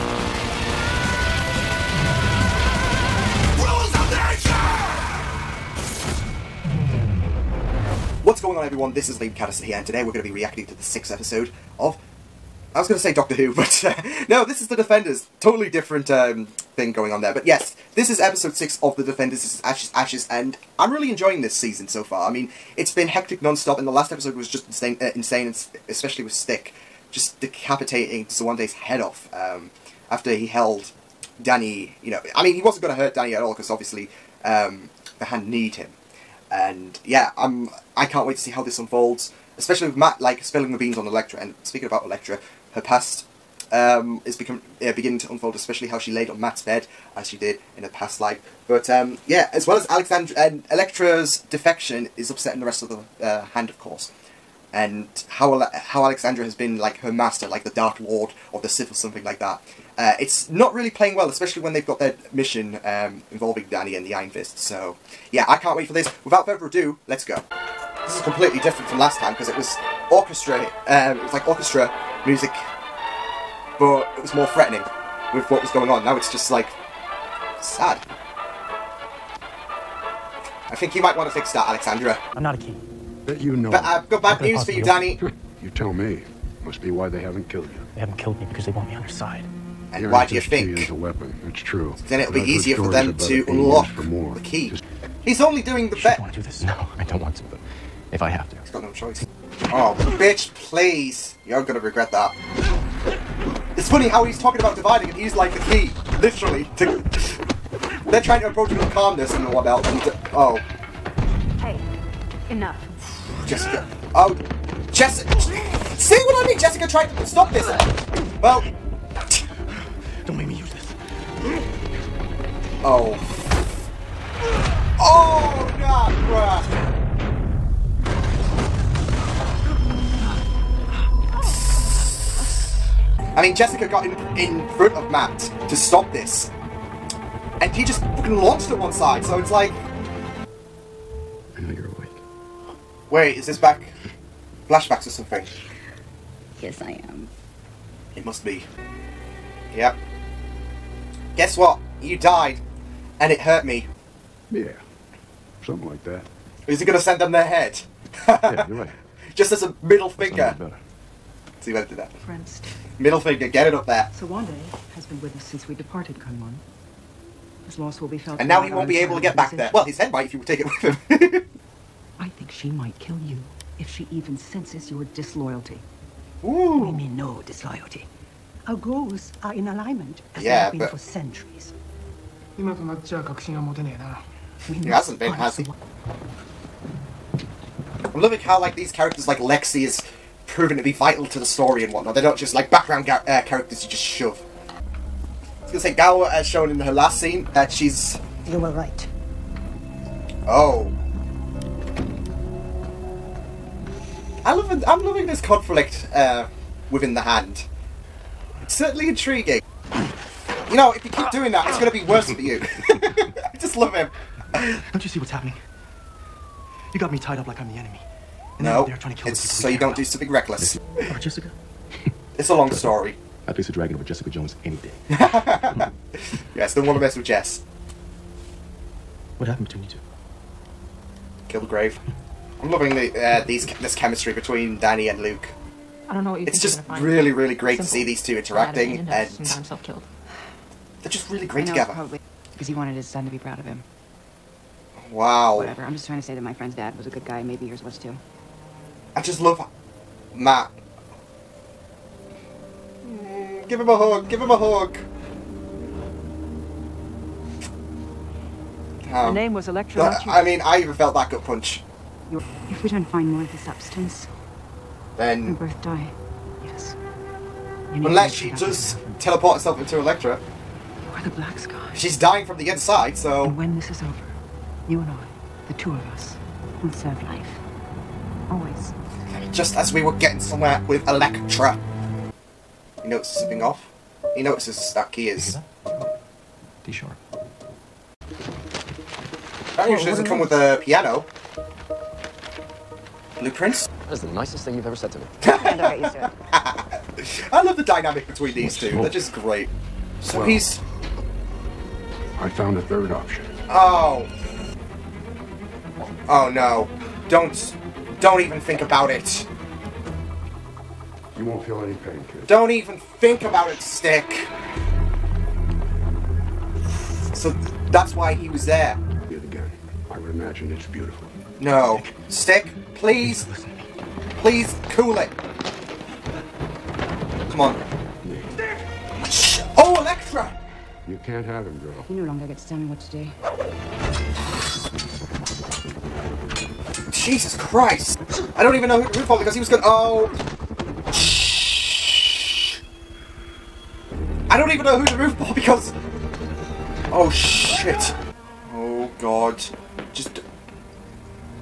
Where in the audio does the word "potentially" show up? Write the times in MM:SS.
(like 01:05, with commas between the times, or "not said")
not said.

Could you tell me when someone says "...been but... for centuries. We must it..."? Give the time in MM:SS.
03:00.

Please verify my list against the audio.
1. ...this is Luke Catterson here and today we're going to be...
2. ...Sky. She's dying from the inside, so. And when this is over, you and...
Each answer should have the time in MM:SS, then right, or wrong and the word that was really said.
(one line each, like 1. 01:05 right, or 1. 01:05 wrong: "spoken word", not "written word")
1. 00:08 wrong: "Liam", not "Luke"
2. 04:31 right.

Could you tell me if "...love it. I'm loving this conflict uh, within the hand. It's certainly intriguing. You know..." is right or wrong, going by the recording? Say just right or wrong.
right.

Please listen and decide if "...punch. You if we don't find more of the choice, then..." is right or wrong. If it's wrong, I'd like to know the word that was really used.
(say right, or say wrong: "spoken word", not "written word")
wrong: "substance", not "choice".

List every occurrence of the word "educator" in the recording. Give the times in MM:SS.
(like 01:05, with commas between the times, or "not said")
not said.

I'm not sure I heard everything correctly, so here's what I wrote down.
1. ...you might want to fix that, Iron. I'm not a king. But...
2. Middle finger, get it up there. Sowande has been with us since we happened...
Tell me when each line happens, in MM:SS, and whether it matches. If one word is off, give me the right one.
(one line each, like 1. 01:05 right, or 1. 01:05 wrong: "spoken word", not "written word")
1. 01:20 wrong: "Alexandra", not "Iron"
2. 02:42 wrong: "departed", not "happened".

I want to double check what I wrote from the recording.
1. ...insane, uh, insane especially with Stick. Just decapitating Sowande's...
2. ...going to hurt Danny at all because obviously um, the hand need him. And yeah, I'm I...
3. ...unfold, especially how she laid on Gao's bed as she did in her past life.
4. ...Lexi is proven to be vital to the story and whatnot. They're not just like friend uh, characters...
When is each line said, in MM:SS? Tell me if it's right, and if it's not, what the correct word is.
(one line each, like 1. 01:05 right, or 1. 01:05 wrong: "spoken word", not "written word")
1. 00:24 right
2. 00:32 right
3. 00:45 wrong: "Matt", not "Gao"
4. 03:09 wrong: "background", not "friend".